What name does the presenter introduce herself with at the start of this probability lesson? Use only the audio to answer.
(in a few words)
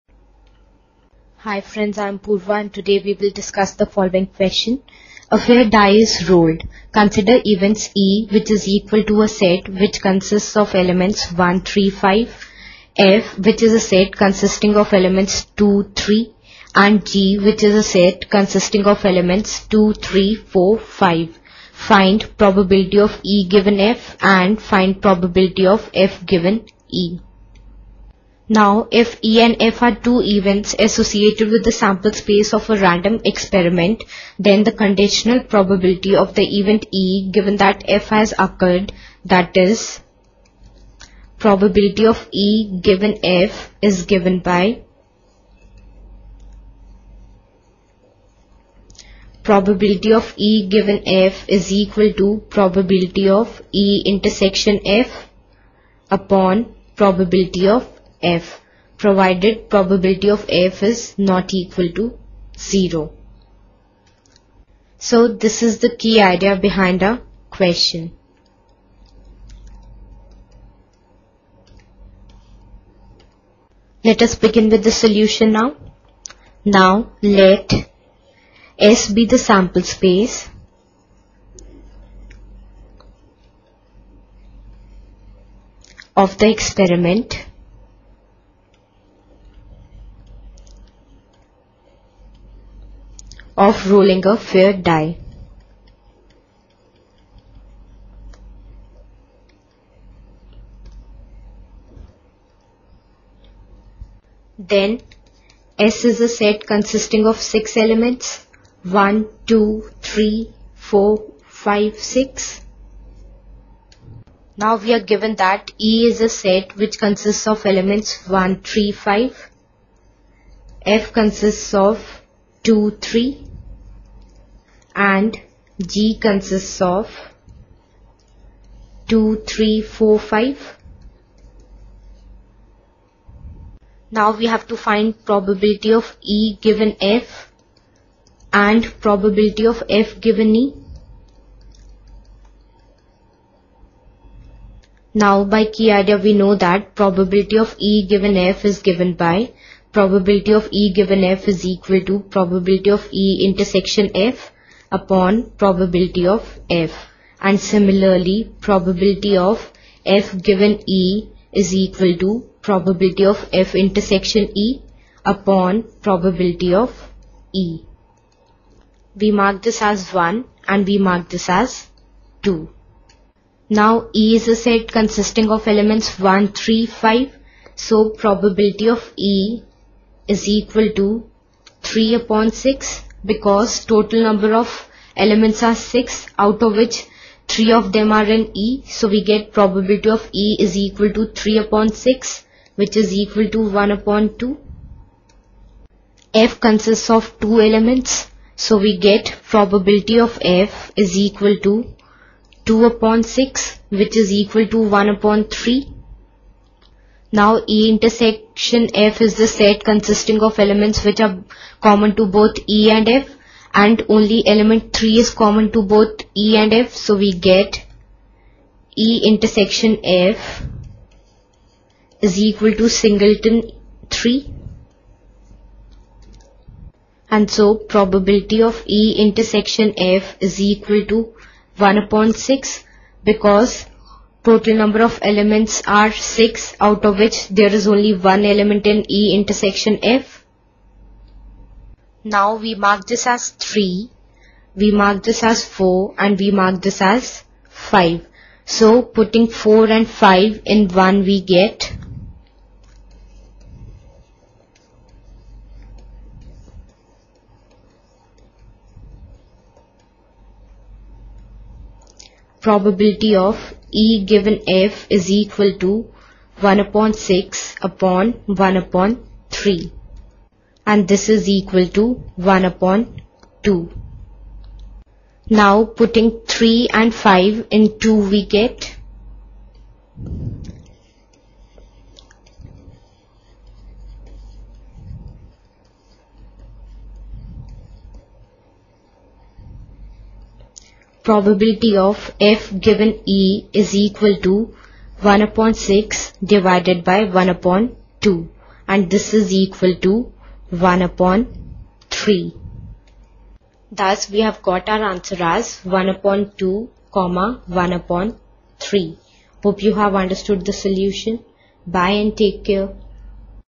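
Purva.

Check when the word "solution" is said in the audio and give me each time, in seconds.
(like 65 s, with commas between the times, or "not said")
74 s, 310 s.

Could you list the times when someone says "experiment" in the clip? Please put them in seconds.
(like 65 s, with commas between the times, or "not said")
33 s, 86 s.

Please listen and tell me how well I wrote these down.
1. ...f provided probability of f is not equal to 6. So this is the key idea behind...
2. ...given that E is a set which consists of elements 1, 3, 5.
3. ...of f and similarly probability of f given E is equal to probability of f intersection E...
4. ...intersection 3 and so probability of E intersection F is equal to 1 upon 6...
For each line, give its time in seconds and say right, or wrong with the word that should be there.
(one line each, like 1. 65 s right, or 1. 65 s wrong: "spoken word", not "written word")
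1. 58 s wrong: "0", not "6"
2. 115 s right
3. 156 s right
4. 222 s wrong: "singleton", not "intersection".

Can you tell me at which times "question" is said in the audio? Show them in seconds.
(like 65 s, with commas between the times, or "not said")
4 s, 67 s.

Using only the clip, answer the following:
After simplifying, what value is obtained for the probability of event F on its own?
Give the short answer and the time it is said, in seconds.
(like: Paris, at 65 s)
1/3, at 204 s.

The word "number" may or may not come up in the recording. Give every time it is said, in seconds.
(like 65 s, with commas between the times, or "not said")
184 s, 234 s.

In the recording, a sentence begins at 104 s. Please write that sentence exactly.
Then S is a set consisting of 6 elements 1, 2, 3, 4, 5, 6.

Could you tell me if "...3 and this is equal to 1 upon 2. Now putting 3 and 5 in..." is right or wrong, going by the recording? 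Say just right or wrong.
right.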